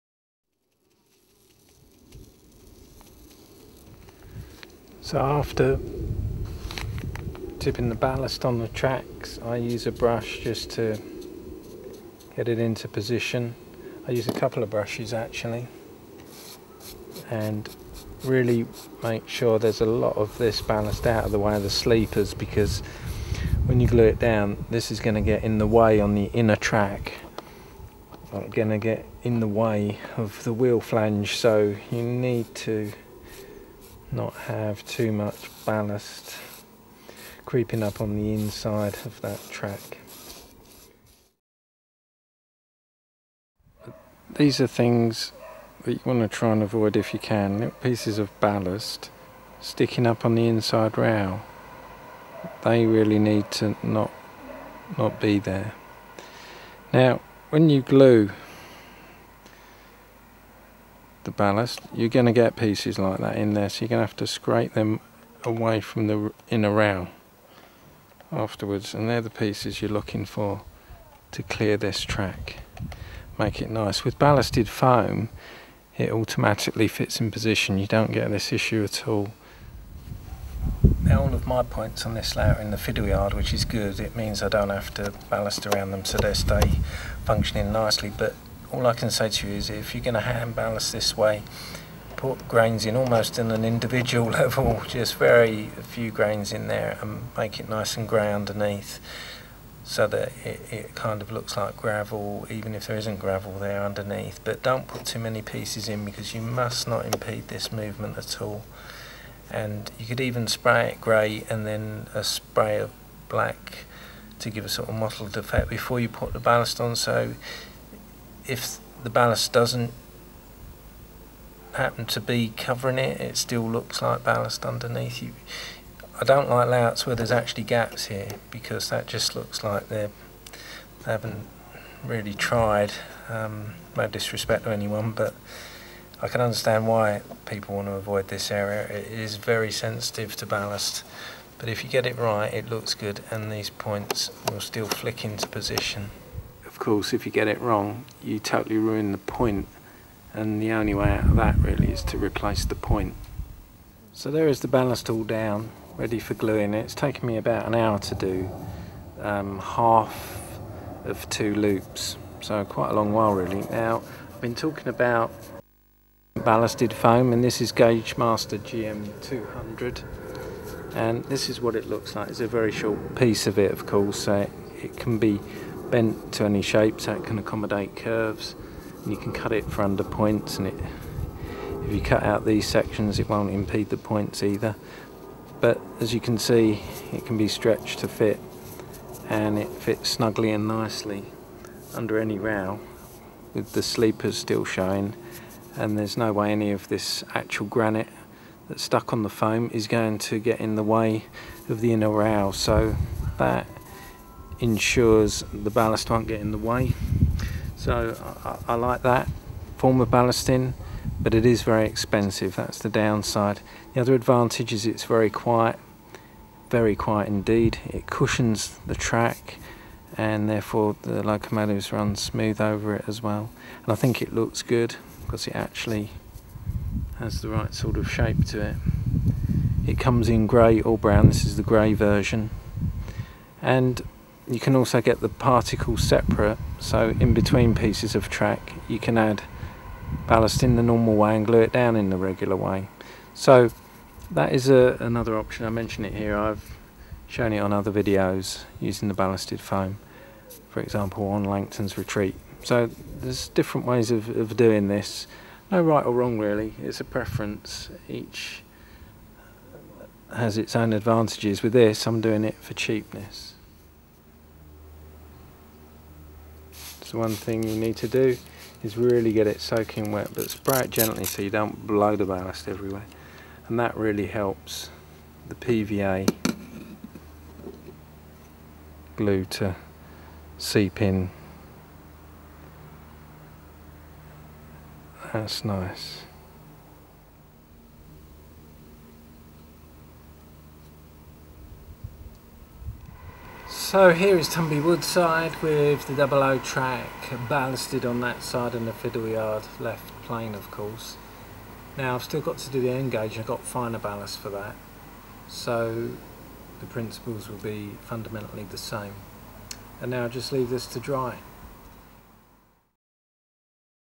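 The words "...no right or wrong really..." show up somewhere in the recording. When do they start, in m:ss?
4:15.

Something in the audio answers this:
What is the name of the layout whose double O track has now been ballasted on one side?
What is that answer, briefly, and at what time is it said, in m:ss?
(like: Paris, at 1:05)
Tumby Woodside, at 4:54.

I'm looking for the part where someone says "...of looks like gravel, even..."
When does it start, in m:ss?
1:41.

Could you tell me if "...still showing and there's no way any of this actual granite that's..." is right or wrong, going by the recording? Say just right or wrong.
right.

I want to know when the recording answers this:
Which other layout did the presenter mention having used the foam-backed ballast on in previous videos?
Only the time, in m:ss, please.
4:11.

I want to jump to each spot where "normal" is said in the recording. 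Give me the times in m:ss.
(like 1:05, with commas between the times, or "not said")
4:00.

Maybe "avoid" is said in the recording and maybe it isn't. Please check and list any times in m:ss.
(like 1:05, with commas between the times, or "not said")
0:46, 2:17.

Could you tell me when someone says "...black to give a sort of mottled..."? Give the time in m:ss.
1:53.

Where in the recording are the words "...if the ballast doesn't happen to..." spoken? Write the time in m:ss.
1:58.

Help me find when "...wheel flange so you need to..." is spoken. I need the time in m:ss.
0:30.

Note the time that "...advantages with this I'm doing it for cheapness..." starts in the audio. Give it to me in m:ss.
4:20.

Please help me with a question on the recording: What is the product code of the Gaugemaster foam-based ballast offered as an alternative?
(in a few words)
GM200.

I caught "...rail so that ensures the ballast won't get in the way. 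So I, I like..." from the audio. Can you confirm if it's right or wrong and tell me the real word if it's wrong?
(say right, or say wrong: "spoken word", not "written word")
right.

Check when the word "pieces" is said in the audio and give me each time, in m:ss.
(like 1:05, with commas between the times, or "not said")
0:47, 1:02, 1:09, 1:45, 2:53, 3:57.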